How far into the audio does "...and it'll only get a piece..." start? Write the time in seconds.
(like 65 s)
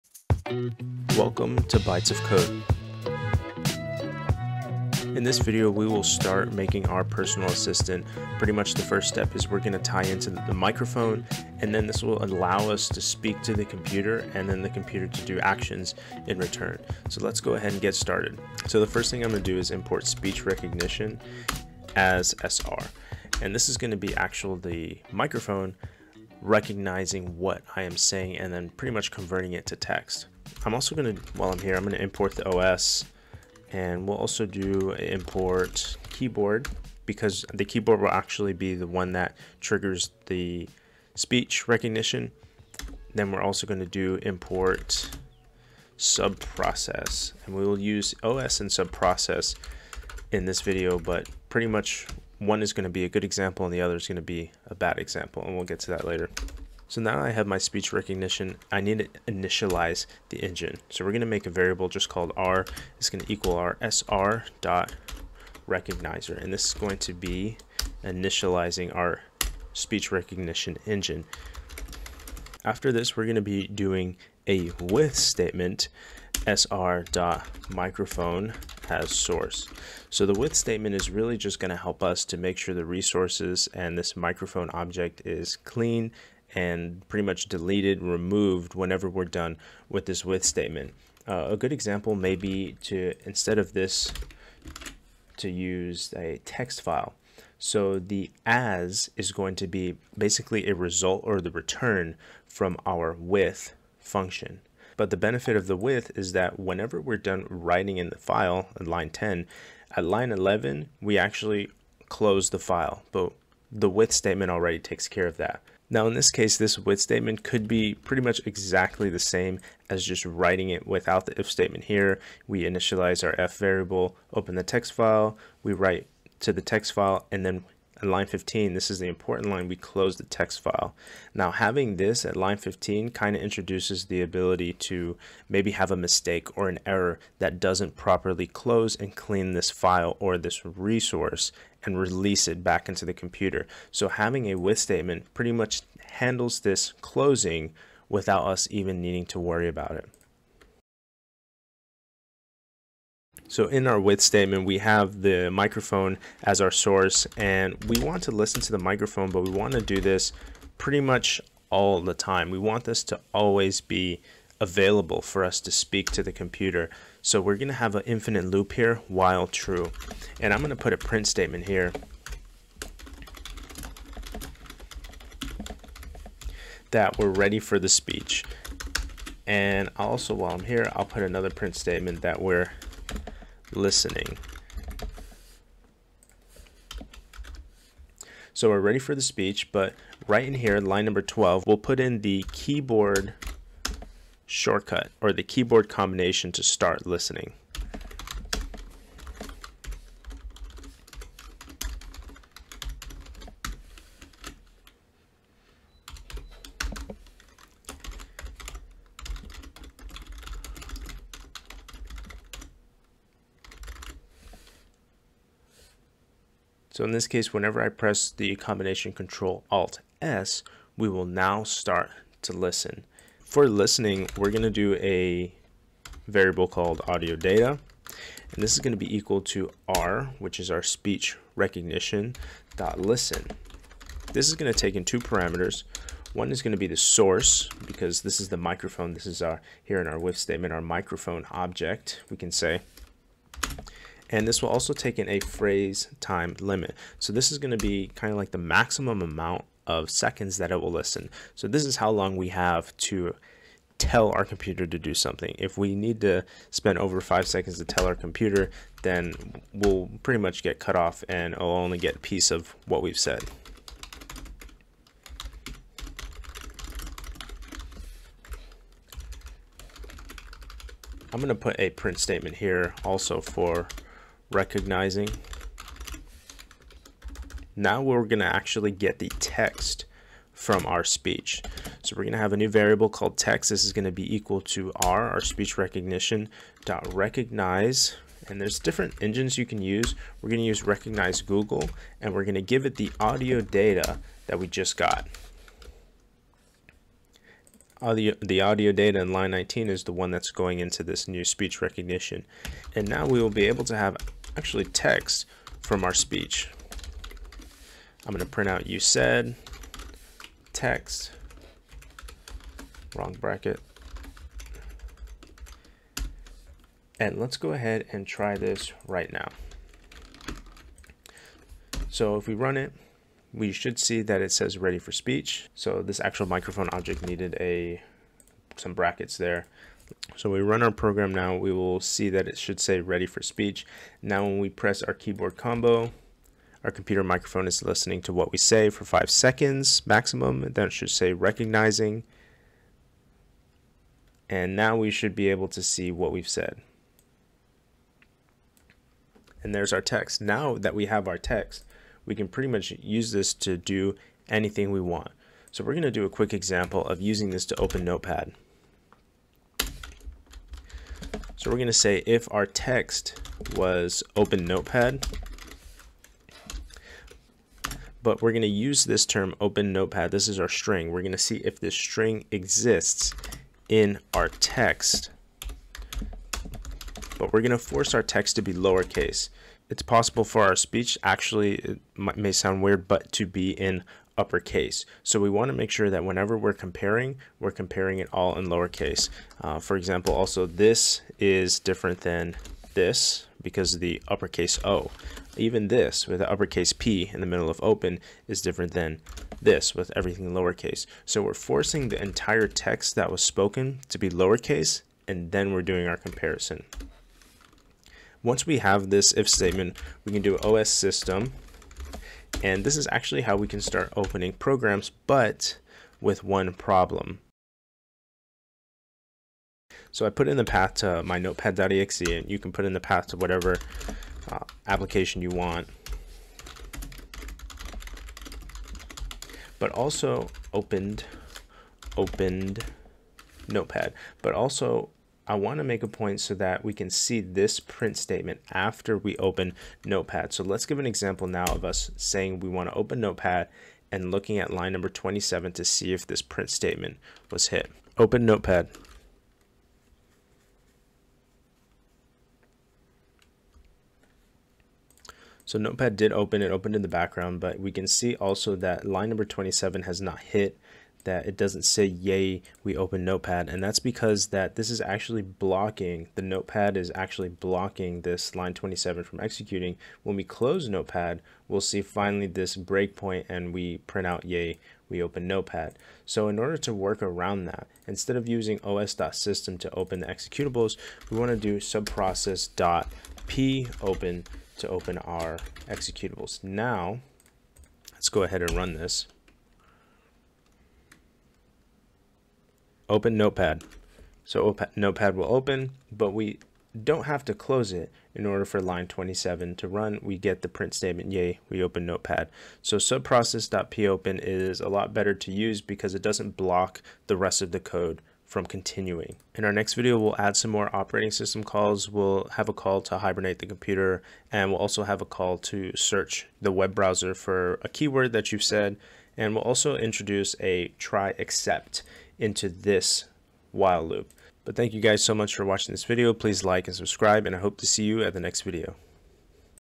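261 s.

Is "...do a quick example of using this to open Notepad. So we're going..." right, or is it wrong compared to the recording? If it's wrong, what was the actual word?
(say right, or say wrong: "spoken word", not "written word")
right.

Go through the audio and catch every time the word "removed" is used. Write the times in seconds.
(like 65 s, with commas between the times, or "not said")
88 s.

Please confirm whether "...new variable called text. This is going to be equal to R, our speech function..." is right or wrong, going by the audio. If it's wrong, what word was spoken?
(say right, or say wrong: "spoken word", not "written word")
wrong: "recognition", not "function".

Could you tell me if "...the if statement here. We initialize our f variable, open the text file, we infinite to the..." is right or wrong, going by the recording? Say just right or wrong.
wrong.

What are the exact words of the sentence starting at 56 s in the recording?
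So now I have my speech recognition, I need to initialize the engine.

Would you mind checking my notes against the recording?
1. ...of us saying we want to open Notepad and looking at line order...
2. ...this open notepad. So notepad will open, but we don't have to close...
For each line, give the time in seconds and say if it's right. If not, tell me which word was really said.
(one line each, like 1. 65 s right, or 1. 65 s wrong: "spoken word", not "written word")
1. 441 s wrong: "number", not "order"
2. 488 s right.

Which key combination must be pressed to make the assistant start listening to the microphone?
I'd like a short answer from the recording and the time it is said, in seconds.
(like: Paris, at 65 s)
Control Alt S, at 219 s.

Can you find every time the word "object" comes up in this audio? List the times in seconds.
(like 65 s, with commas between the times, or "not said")
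84 s, 241 s, 326 s.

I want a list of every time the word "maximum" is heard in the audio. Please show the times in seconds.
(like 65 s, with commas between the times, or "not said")
248 s, 340 s.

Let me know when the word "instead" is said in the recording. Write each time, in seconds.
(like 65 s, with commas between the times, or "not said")
93 s, 478 s.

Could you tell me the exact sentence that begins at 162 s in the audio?
We want this to always be available for us to speak to the computer.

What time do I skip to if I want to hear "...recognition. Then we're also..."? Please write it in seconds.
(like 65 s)
41 s.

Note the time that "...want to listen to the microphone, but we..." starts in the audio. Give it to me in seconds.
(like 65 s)
158 s.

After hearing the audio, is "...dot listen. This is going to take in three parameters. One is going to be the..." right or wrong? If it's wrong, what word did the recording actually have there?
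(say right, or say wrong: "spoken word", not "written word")
wrong: "two", not "three".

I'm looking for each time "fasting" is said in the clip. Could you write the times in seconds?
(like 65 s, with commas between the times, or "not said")
not said.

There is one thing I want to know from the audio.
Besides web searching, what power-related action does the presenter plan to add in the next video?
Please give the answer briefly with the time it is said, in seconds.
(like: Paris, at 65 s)
hibernate, at 513 s.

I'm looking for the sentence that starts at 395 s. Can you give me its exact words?
Even this with the uppercase P in the middle of open is different than this with everything lowercase.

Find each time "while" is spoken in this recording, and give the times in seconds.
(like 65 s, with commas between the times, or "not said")
31 s, 169 s, 180 s, 523 s.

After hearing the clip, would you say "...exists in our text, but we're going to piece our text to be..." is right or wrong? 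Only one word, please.
wrong.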